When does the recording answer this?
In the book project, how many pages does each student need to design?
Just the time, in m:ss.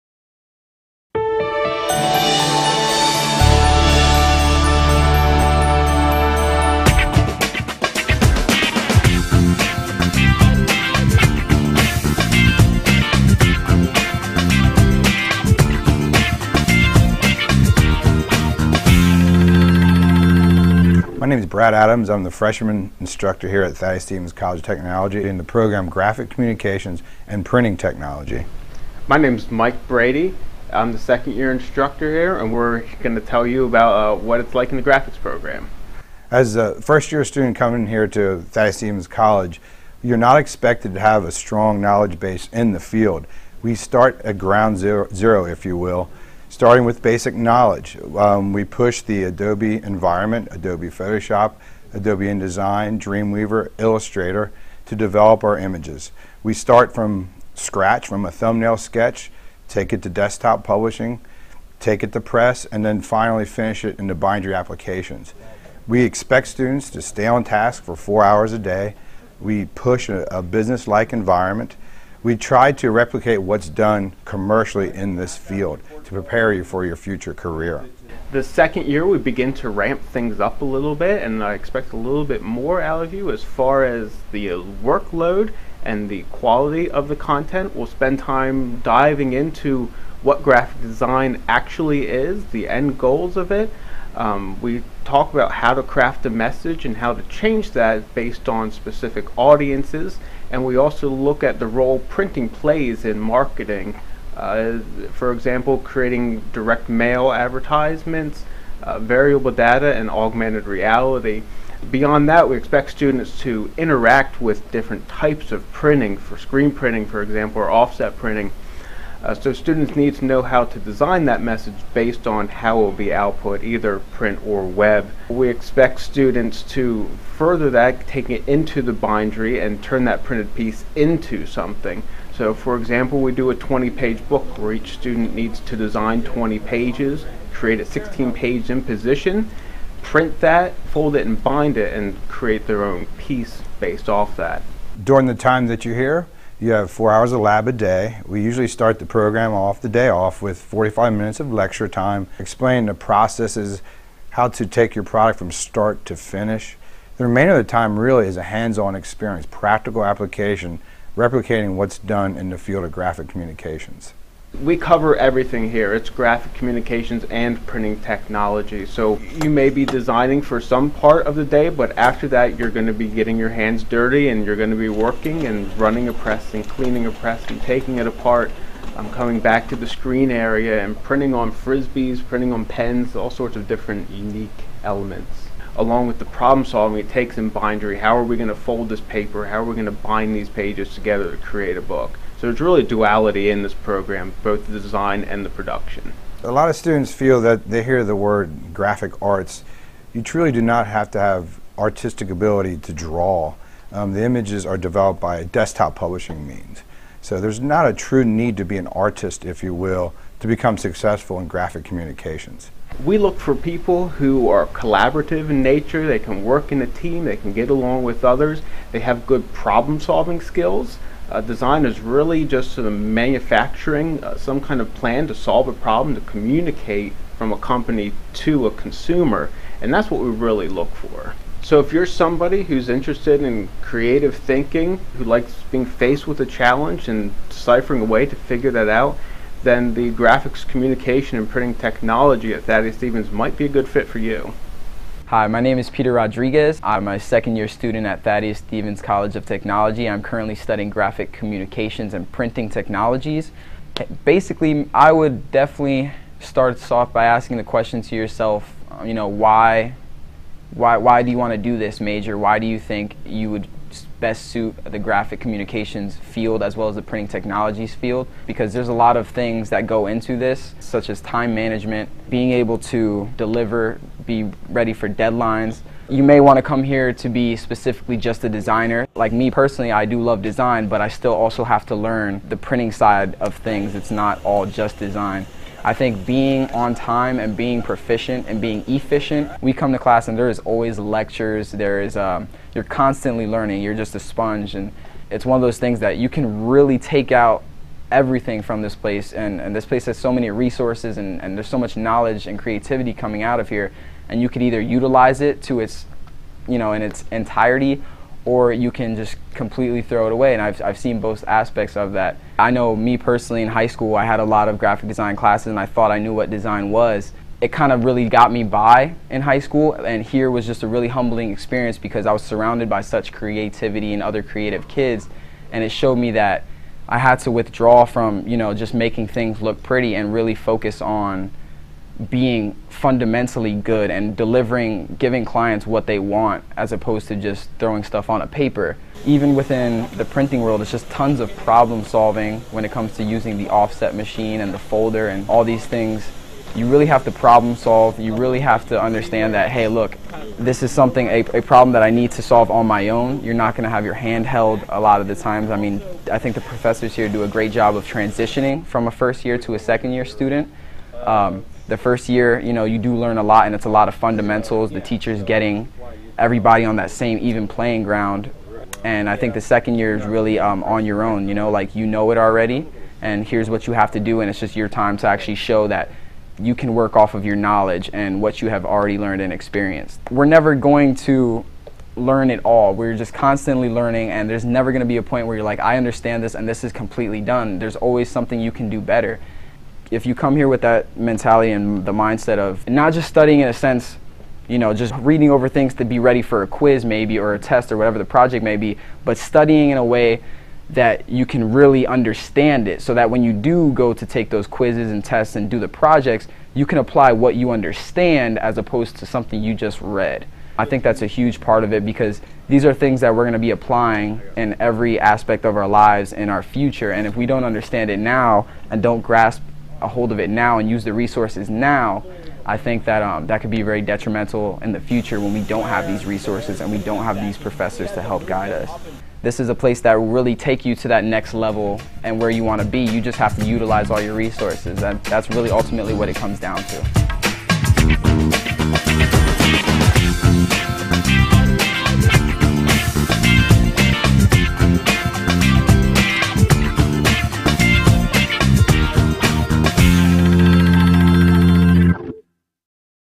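2:16.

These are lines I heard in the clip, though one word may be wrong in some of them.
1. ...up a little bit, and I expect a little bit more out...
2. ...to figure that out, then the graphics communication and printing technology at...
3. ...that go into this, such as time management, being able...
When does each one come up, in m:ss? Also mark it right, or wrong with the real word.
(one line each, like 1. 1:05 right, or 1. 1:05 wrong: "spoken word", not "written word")
1. 1:20 right
2. 3:58 right
3. 4:29 right.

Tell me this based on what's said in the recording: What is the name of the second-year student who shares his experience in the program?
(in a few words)
Peter Rodriguez.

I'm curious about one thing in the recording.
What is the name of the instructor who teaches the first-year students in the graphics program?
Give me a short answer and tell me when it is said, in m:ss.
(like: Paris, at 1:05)
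Brad Adams, at 0:21.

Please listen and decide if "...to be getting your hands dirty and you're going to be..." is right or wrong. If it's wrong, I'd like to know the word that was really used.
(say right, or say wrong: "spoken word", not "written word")
right.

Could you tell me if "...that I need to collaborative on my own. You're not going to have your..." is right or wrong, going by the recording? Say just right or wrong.
wrong.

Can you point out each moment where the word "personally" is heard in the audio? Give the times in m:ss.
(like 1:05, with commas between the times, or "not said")
4:39, 5:13.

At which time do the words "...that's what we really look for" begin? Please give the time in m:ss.
3:49.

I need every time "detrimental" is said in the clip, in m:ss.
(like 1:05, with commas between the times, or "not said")
7:04.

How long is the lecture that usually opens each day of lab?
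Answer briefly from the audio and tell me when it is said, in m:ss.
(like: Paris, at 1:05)
45 minutes, at 2:30.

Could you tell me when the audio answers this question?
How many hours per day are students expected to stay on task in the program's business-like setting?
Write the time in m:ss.
1:07.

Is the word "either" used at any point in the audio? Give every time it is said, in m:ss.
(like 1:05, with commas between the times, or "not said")
2:03, 5:04.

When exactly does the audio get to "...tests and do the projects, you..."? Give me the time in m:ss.
6:45.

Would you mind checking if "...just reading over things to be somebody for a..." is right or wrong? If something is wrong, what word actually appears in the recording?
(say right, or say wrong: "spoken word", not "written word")
wrong: "ready", not "somebody".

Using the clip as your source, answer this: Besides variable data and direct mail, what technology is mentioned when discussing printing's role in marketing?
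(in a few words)
augmented reality.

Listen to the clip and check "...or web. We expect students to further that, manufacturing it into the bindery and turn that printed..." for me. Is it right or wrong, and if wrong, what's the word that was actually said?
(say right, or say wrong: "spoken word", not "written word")
wrong: "taking", not "manufacturing".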